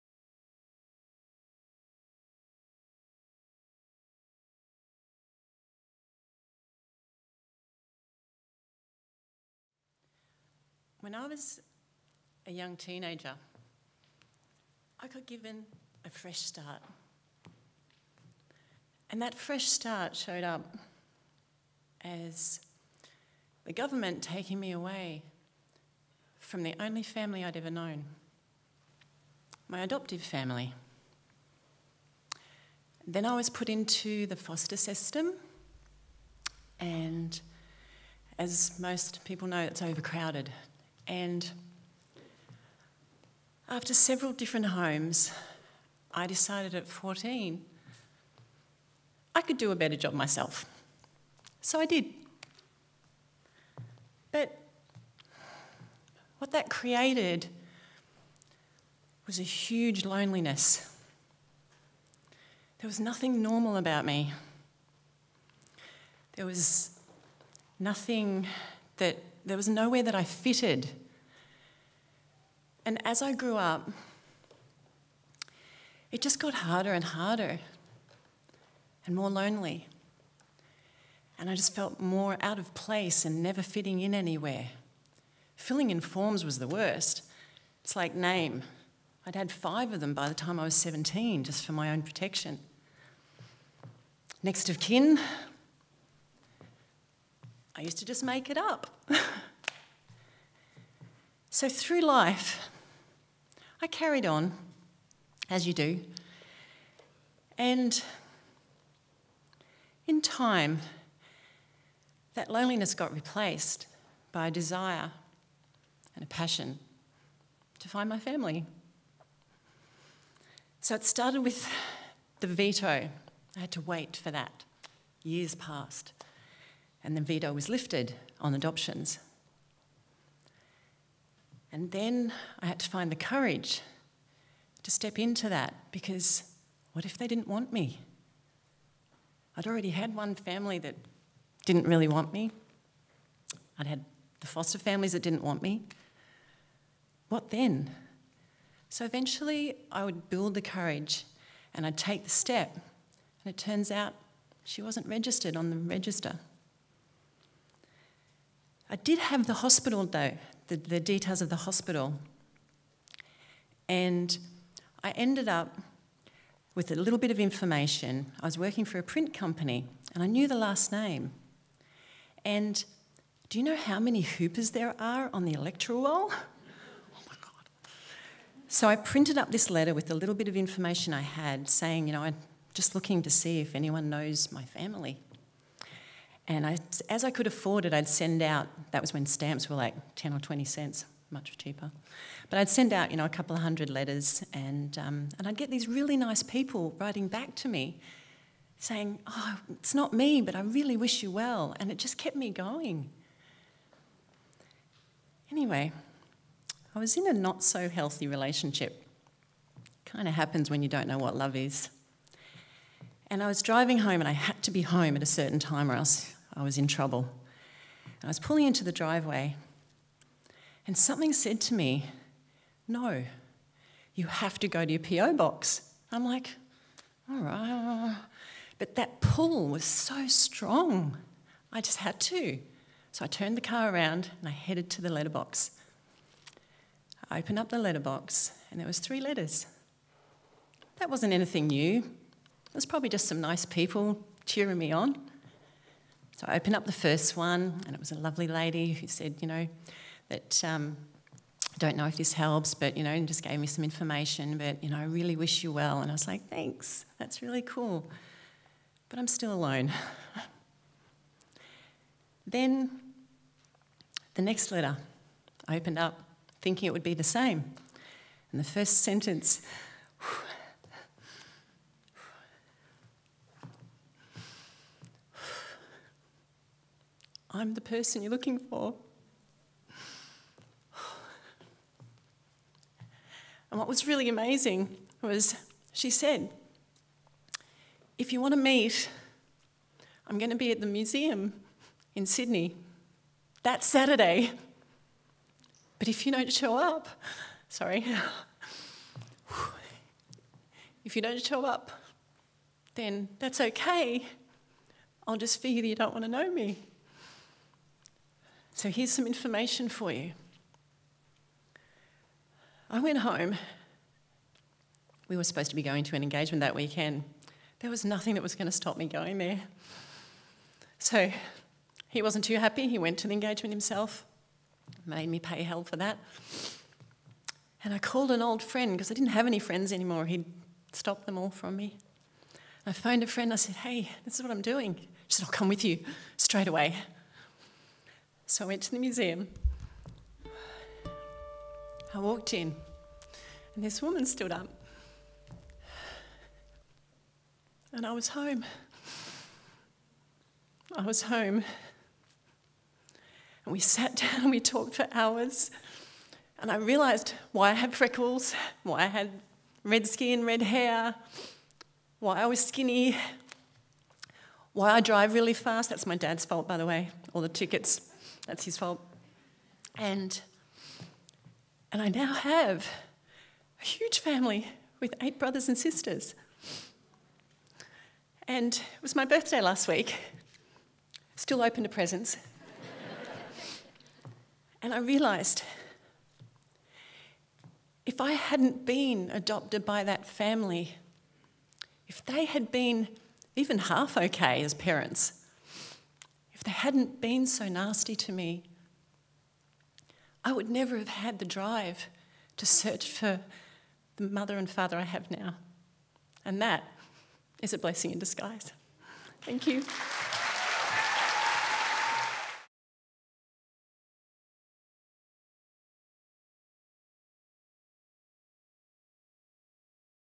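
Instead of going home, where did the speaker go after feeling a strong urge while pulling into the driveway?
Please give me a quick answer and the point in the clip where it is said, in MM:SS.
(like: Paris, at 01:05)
PO box, at 03:44.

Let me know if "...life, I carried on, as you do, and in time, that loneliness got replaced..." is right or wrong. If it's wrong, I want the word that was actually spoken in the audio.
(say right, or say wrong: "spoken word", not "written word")
right.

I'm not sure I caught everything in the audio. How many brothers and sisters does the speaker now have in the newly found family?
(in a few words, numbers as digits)
8.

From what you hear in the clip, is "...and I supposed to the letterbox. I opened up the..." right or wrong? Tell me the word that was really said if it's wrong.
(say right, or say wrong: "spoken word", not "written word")
wrong: "headed", not "supposed".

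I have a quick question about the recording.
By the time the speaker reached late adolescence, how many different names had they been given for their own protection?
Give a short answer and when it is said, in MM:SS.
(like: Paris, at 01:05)
5, at 01:29.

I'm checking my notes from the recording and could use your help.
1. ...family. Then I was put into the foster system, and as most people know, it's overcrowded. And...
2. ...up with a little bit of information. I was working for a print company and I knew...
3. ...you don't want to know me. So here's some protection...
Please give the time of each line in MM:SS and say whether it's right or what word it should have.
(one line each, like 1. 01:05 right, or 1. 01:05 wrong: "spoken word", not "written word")
1. 00:30 right
2. 02:45 right
3. 05:05 wrong: "information", not "protection".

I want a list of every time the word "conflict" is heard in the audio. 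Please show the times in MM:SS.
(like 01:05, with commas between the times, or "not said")
not said.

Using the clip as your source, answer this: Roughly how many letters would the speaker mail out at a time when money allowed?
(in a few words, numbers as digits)
A couple of hundred.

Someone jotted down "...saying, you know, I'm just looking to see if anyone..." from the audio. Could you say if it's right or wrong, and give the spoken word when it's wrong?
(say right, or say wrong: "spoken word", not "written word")
right.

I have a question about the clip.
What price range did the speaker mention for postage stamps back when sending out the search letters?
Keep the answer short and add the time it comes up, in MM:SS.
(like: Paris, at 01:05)
10 or 20 cents, at 03:10.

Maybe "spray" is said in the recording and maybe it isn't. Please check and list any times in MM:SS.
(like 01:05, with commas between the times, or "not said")
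not said.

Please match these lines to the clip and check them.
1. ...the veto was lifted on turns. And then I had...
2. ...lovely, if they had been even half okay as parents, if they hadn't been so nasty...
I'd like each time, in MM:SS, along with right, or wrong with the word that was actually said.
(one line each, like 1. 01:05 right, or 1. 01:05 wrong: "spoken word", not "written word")
1. 02:07 wrong: "adoptions", not "turns"
2. 06:30 wrong: "family", not "lovely".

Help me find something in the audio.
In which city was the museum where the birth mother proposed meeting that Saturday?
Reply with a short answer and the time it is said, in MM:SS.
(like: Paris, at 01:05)
Sydney, at 04:52.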